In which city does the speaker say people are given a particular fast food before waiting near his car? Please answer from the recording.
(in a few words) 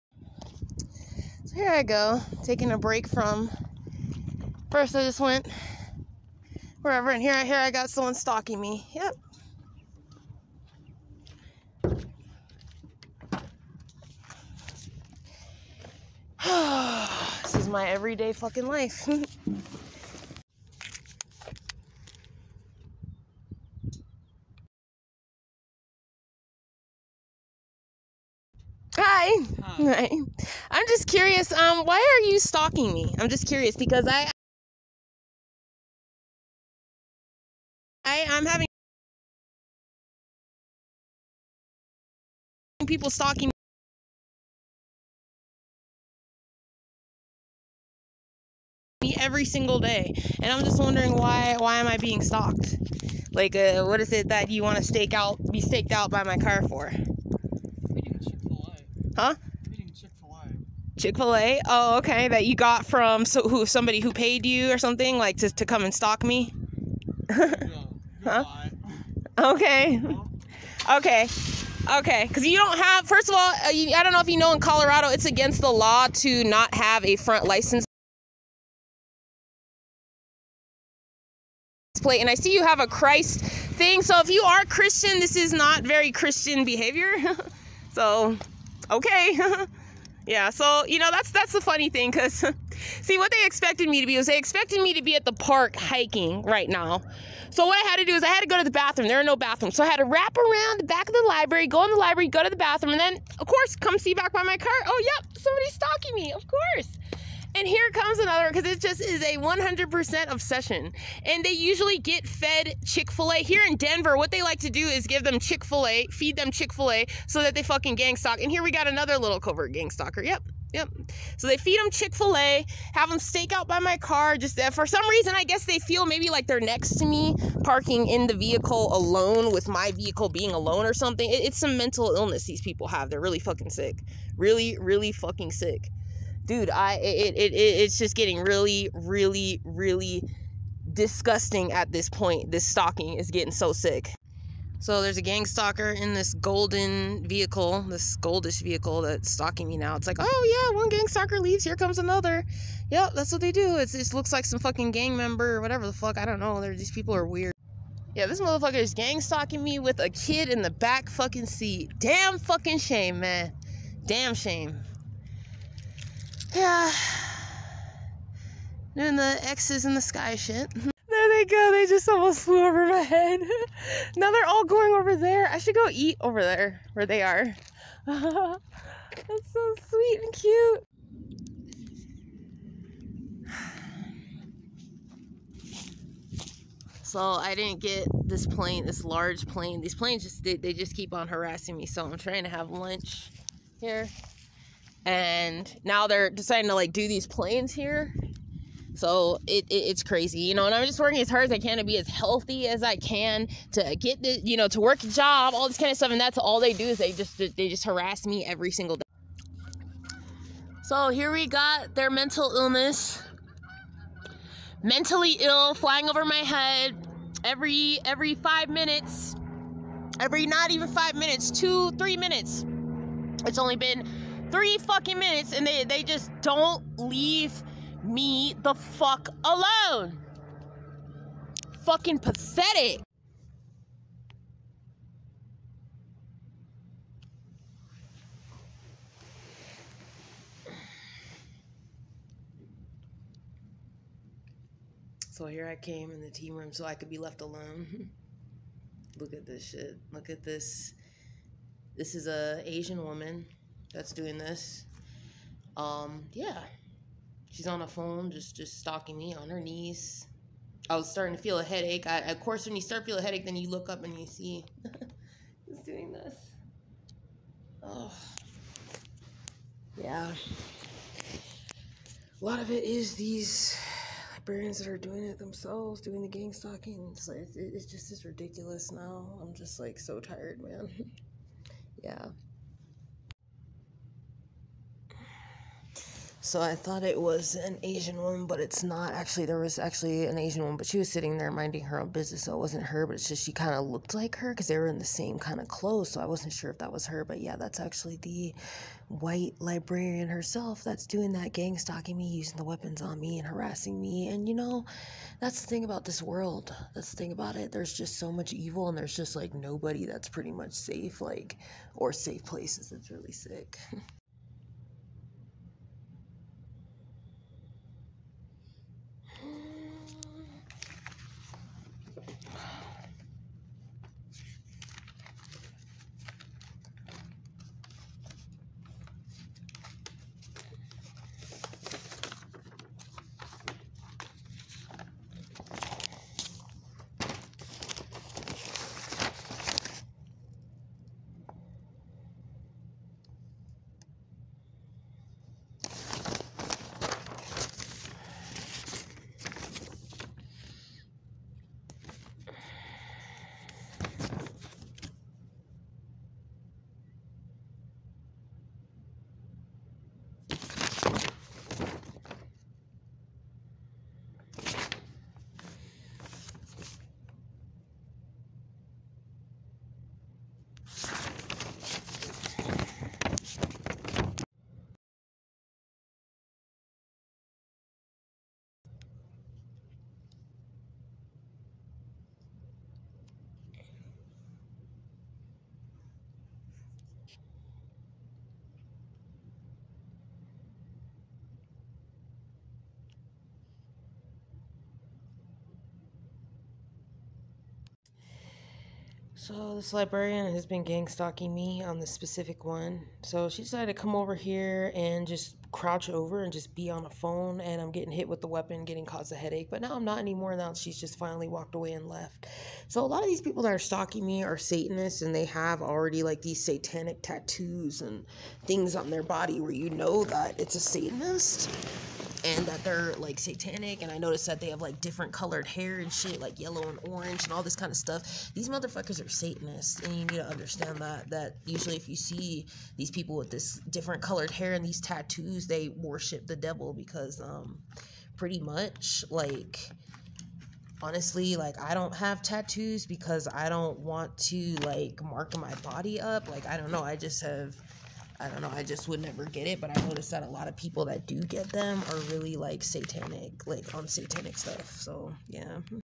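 Denver.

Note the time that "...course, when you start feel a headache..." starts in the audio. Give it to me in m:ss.
4:22.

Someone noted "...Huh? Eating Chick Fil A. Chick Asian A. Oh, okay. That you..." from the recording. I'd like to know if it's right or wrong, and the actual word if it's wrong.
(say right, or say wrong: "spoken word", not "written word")
wrong: "Fil", not "Asian".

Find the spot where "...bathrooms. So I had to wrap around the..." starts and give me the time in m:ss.
1:39.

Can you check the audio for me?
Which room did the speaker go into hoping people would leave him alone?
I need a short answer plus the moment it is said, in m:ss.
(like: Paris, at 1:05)
the team room, at 4:06.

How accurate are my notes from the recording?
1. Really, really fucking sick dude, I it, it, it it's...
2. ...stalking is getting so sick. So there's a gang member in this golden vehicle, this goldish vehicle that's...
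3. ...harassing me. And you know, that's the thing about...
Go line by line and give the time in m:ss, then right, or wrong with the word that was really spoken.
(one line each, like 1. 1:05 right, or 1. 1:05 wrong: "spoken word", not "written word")
1. 2:14 right
2. 2:22 wrong: "stalker", not "member"
3. 5:03 right.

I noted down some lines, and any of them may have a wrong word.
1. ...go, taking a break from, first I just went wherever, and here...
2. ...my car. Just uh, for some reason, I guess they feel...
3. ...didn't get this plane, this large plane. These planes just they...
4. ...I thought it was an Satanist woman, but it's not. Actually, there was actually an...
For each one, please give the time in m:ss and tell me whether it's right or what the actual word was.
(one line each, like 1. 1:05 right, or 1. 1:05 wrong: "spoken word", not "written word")
1. 0:01 right
2. 2:03 right
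3. 3:07 right
4. 4:46 wrong: "Asian", not "Satanist".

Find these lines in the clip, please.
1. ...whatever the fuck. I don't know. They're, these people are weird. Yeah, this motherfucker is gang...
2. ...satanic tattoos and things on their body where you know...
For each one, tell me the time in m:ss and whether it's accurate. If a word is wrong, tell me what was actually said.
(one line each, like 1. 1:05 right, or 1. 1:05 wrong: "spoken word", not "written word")
1. 2:35 right
2. 6:56 right.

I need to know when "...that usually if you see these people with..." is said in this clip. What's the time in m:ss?
7:11.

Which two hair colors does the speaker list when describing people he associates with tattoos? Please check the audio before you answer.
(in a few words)
yellow and orange.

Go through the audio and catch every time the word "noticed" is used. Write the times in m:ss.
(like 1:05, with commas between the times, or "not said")
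7:04, 7:30.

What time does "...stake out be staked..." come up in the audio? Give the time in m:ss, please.
0:54.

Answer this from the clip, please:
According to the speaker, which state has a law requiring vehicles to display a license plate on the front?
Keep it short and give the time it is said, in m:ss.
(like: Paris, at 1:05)
Colorado, at 1:14.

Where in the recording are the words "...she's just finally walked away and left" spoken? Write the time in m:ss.
6:50.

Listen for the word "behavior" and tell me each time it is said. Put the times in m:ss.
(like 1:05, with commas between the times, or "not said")
1:26.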